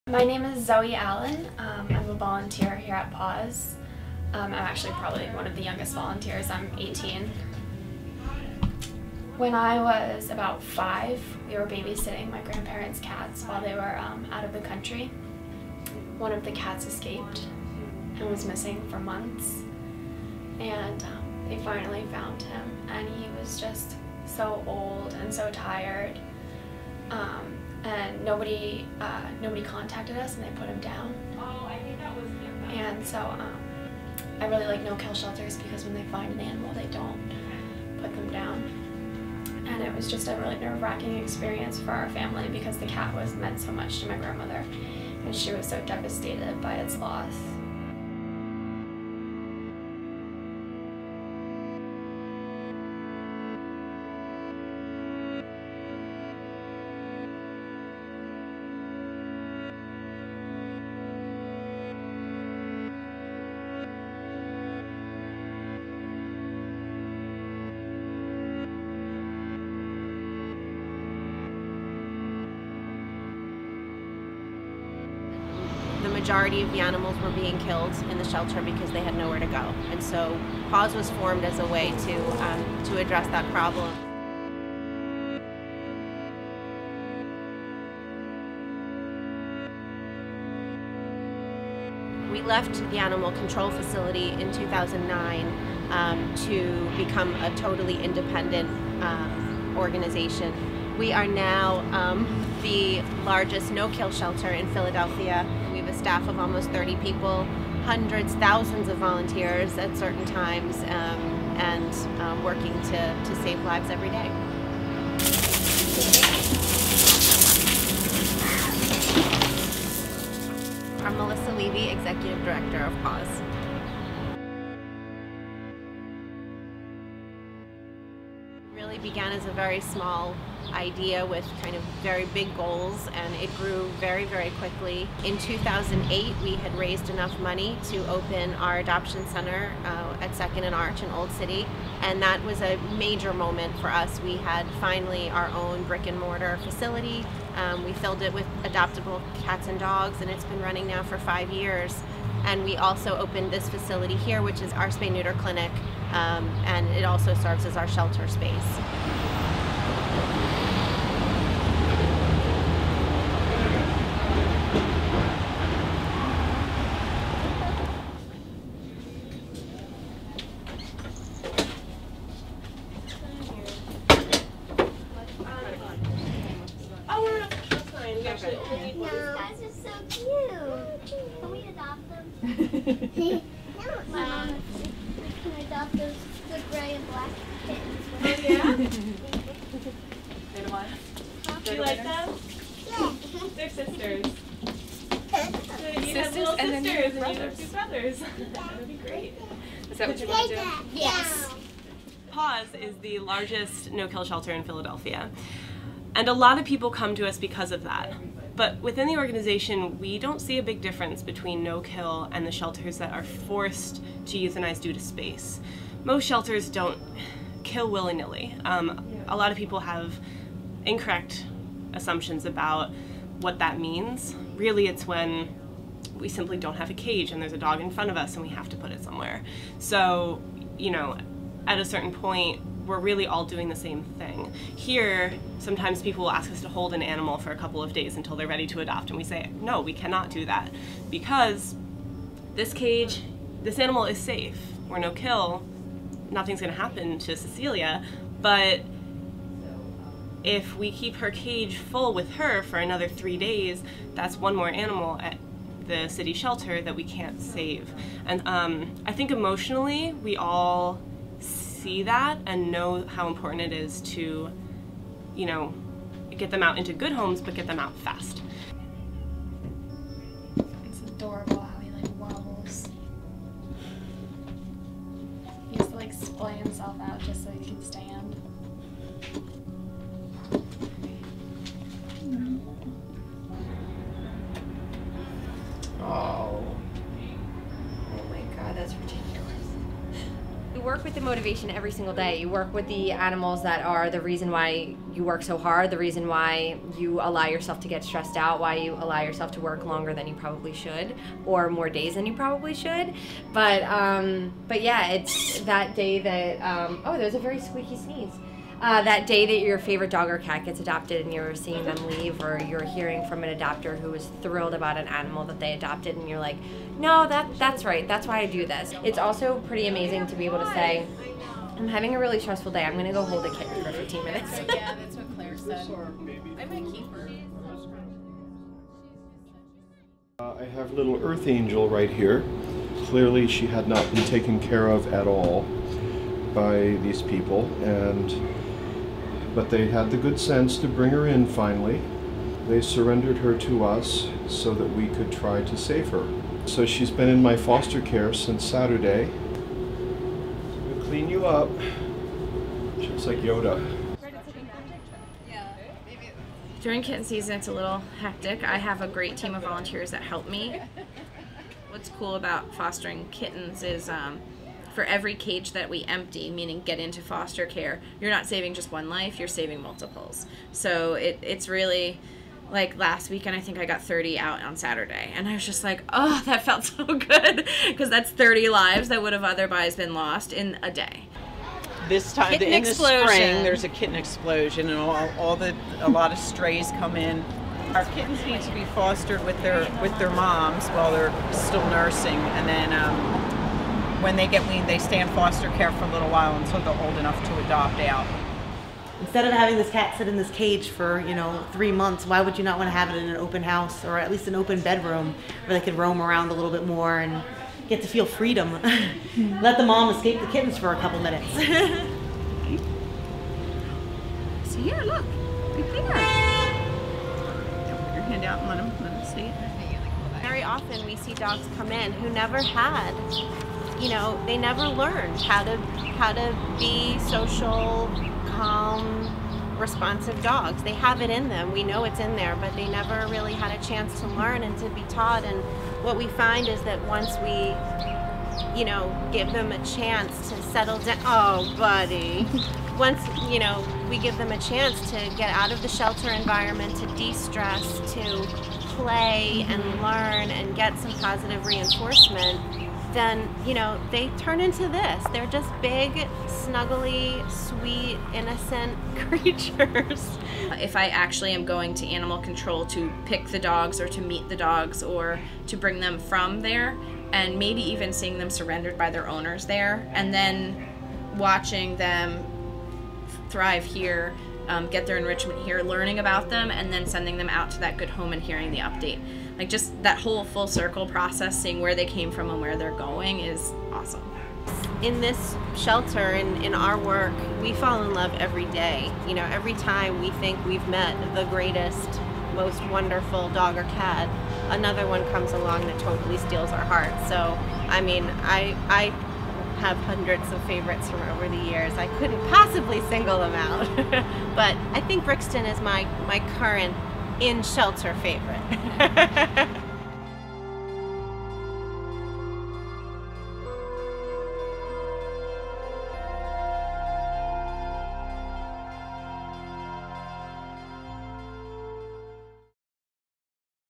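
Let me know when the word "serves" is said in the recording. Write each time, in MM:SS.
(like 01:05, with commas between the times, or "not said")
02:37.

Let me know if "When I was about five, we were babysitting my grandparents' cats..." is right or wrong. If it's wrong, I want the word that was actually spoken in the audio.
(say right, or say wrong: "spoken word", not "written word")
right.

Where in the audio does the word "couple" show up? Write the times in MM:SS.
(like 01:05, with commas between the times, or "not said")
03:57, 06:50.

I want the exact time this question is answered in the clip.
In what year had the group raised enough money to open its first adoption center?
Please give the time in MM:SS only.
02:15.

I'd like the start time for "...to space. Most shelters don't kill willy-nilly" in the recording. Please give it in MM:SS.
03:34.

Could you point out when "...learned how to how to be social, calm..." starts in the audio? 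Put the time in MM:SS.
07:04.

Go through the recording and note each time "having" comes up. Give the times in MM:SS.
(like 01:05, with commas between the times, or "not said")
05:21, 06:39.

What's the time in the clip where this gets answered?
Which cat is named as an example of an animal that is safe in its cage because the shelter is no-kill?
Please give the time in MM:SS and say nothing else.
04:07.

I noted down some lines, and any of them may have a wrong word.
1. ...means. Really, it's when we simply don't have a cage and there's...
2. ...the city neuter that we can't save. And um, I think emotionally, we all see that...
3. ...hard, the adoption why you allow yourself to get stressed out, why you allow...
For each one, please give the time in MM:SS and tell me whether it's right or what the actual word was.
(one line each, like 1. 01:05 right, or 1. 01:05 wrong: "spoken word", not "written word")
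1. 03:43 right
2. 04:15 wrong: "shelter", not "neuter"
3. 04:55 wrong: "reason", not "adoption".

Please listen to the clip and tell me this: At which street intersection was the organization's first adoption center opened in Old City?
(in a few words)
Second and Arch.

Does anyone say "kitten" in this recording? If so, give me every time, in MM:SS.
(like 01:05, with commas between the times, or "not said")
05:23, 05:57, 06:03, 06:23, 06:28, 06:50.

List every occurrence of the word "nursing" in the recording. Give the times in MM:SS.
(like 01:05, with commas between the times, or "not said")
06:31.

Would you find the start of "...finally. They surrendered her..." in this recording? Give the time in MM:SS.
05:41.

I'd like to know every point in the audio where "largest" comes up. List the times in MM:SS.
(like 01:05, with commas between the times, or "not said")
01:43, 03:23.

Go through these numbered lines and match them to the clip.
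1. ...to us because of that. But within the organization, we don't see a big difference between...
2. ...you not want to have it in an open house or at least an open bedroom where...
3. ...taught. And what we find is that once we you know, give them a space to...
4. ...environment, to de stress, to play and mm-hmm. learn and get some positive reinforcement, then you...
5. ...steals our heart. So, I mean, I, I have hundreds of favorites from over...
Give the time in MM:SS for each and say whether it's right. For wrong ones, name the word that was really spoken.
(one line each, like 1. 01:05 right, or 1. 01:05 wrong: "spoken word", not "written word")
1. 03:27 right
2. 06:42 right
3. 07:15 wrong: "chance", not "space"
4. 07:26 right
5. 08:16 right.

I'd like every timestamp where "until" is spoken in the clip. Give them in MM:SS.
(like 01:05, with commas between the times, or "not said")
03:58, 06:36.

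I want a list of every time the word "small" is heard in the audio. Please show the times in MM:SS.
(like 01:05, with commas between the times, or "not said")
02:09.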